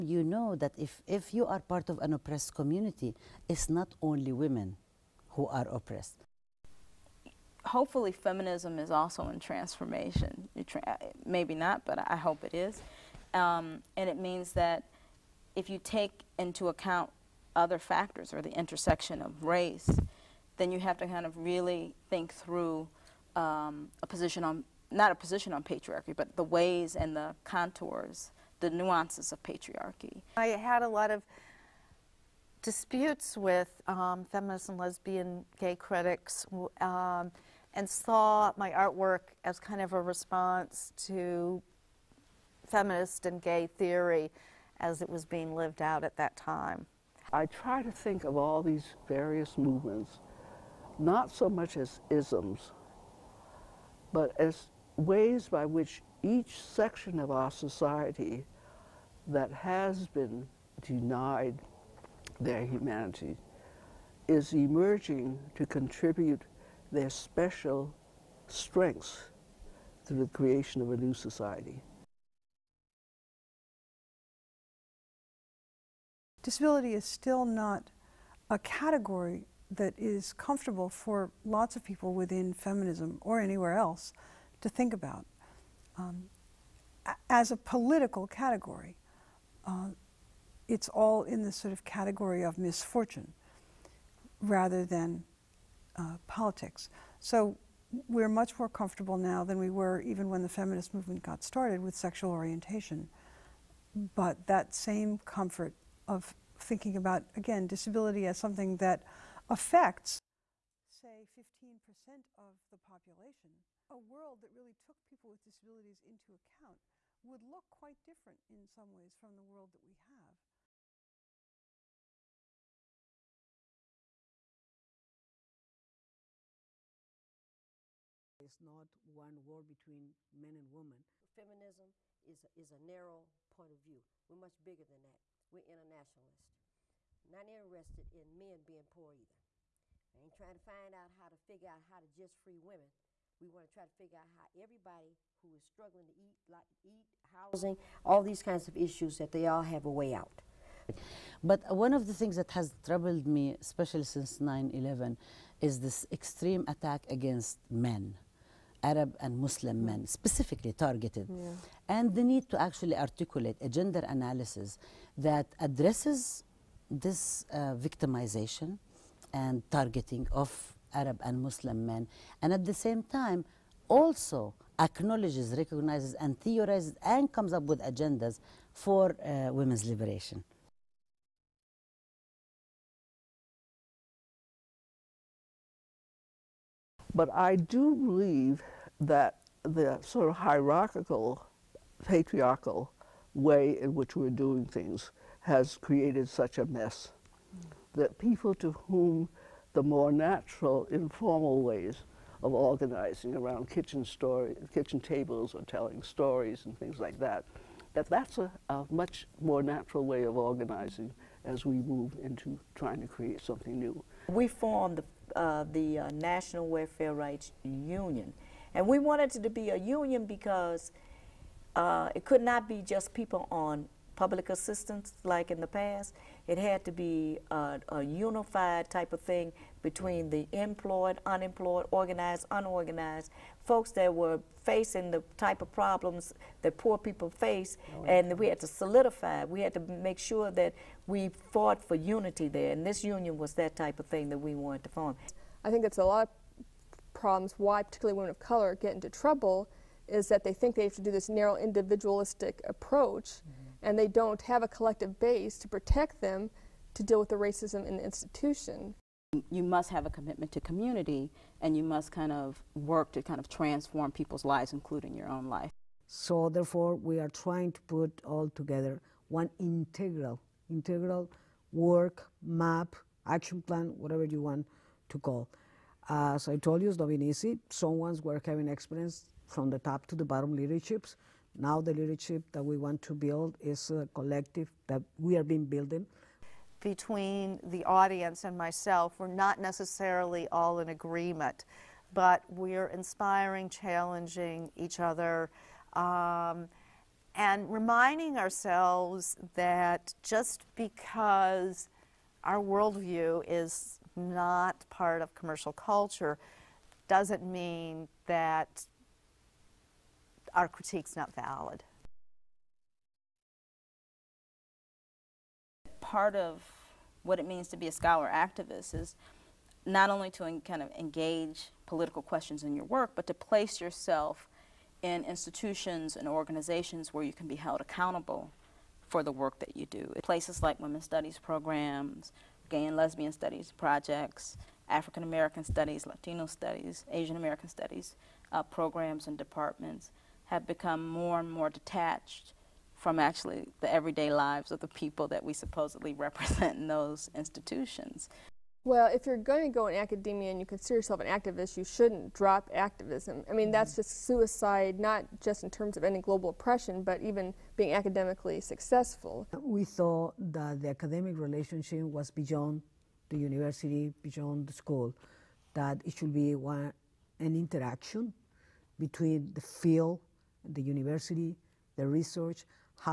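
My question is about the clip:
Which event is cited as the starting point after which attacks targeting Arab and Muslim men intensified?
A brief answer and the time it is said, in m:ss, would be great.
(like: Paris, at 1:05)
9-11, at 2:34.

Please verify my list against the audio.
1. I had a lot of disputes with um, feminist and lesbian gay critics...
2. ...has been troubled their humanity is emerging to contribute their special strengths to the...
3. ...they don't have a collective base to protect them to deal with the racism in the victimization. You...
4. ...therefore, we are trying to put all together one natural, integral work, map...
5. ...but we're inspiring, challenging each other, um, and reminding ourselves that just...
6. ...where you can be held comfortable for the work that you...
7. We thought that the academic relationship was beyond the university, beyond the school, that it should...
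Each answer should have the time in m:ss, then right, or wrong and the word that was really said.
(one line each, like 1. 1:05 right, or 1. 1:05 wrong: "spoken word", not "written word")
1. 0:30 right
2. 0:59 wrong: "denied", not "troubled"
3. 4:13 wrong: "institution", not "victimization"
4. 4:26 wrong: "integral", not "natural"
5. 4:52 right
6. 5:27 wrong: "accountable", not "comfortable"
7. 5:59 right.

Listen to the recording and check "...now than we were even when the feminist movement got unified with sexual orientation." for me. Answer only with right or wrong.
wrong.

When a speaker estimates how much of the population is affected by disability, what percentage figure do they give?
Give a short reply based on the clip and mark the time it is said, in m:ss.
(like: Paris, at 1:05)
15%, at 1:51.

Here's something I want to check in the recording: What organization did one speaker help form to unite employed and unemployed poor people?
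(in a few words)
National Welfare Rights Union.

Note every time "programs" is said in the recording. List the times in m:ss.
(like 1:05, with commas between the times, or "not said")
5:31, 5:38.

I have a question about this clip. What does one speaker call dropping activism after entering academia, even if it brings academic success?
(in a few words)
suicide.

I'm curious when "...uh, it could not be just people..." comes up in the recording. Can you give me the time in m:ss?
3:41.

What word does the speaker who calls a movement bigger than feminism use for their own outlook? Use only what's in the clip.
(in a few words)
internationalist.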